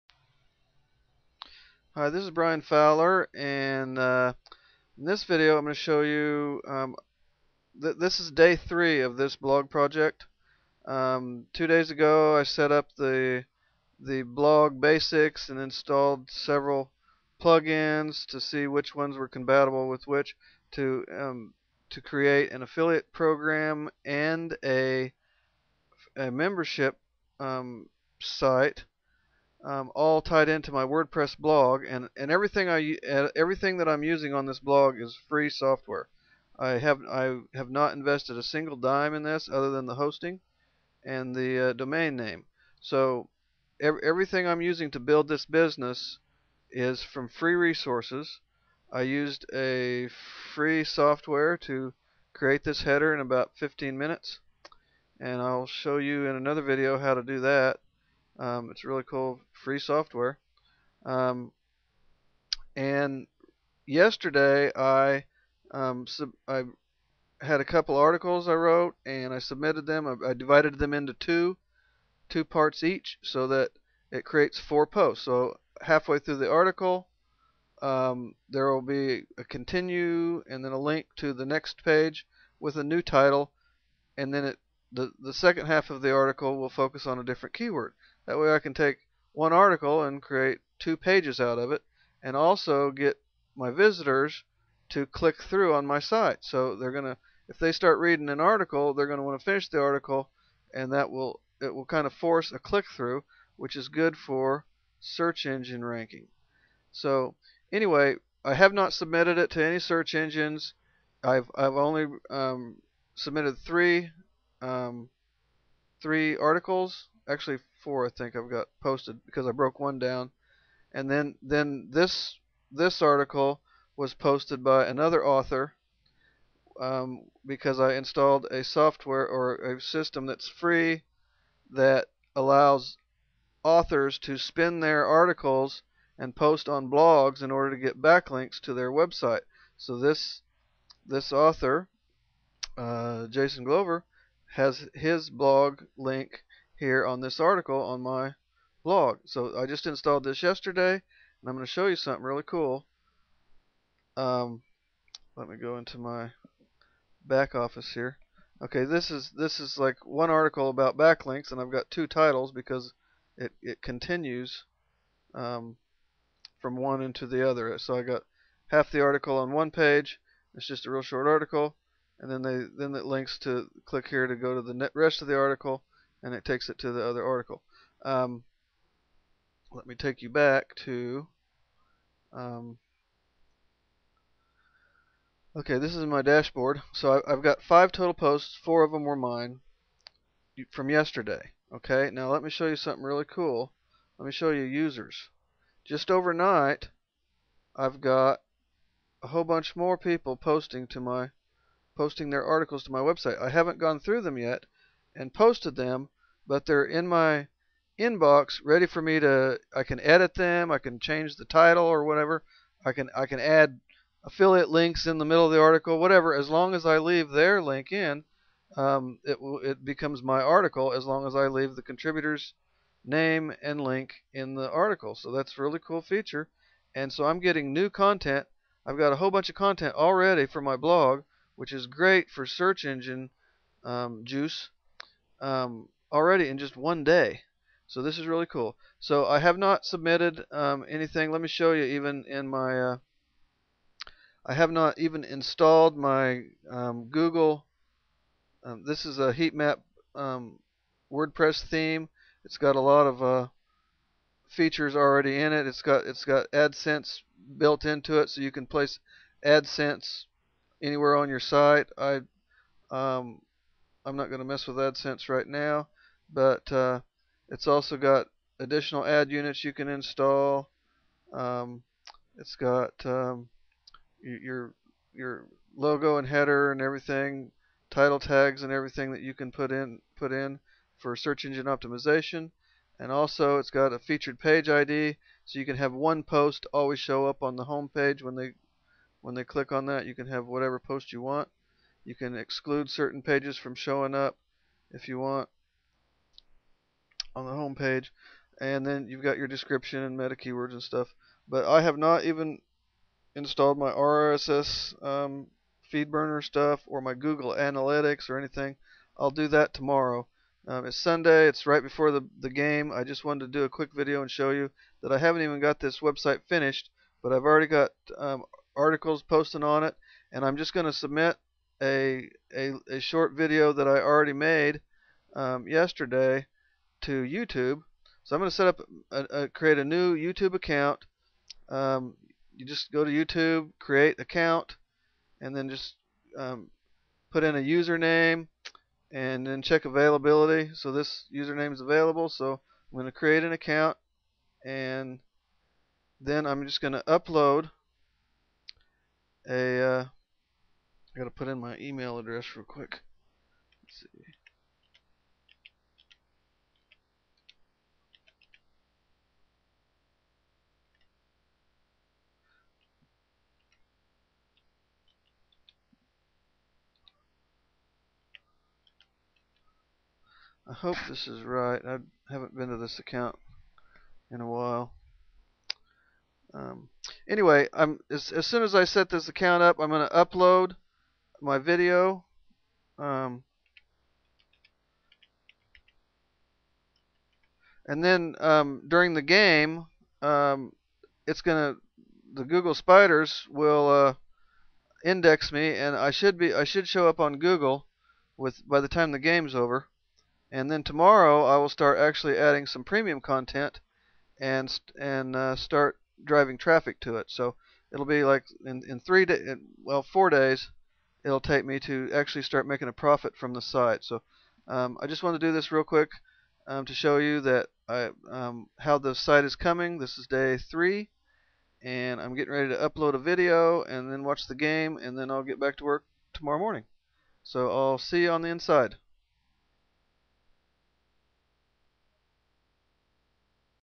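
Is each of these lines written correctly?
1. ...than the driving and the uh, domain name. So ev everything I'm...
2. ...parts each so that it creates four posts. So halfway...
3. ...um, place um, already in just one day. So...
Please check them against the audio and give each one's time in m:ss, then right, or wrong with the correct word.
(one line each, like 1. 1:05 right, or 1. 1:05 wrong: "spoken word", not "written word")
1. 0:39 wrong: "hosting", not "driving"
2. 1:12 right
3. 3:53 wrong: "juice", not "place".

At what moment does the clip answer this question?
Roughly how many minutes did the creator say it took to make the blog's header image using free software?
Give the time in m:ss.
0:53.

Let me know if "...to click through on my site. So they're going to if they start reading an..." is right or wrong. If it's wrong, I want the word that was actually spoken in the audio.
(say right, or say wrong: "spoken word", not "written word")
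right.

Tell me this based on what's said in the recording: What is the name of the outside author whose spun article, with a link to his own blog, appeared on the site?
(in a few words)
Jason Glover.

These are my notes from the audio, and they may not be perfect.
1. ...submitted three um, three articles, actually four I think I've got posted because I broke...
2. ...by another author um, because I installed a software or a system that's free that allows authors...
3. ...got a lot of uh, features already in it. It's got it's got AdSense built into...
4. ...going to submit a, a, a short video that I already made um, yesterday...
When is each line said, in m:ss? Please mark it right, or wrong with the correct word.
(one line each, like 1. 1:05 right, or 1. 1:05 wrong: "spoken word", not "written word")
1. 1:53 right
2. 2:04 right
3. 4:12 right
4. 5:20 right.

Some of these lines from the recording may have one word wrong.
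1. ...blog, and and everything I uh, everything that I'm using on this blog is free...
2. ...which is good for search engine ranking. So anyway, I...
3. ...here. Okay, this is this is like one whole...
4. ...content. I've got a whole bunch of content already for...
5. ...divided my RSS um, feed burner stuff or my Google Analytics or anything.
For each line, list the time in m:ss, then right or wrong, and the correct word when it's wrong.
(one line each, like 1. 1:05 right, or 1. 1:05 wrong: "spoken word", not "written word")
1. 0:31 right
2. 1:43 right
3. 2:37 wrong: "article", not "whole"
4. 3:47 right
5. 5:03 wrong: "installed", not "divided".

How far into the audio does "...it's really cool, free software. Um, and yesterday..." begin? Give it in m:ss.
0:58.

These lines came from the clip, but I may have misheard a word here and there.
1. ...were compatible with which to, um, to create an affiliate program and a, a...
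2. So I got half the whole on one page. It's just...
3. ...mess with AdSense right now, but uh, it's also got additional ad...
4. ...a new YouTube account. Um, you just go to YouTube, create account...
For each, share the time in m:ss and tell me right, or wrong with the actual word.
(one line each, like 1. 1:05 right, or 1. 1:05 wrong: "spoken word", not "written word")
1. 0:19 right
2. 2:47 wrong: "article", not "whole"
3. 4:24 right
4. 5:29 right.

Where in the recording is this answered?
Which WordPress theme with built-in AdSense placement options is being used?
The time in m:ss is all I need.
4:09.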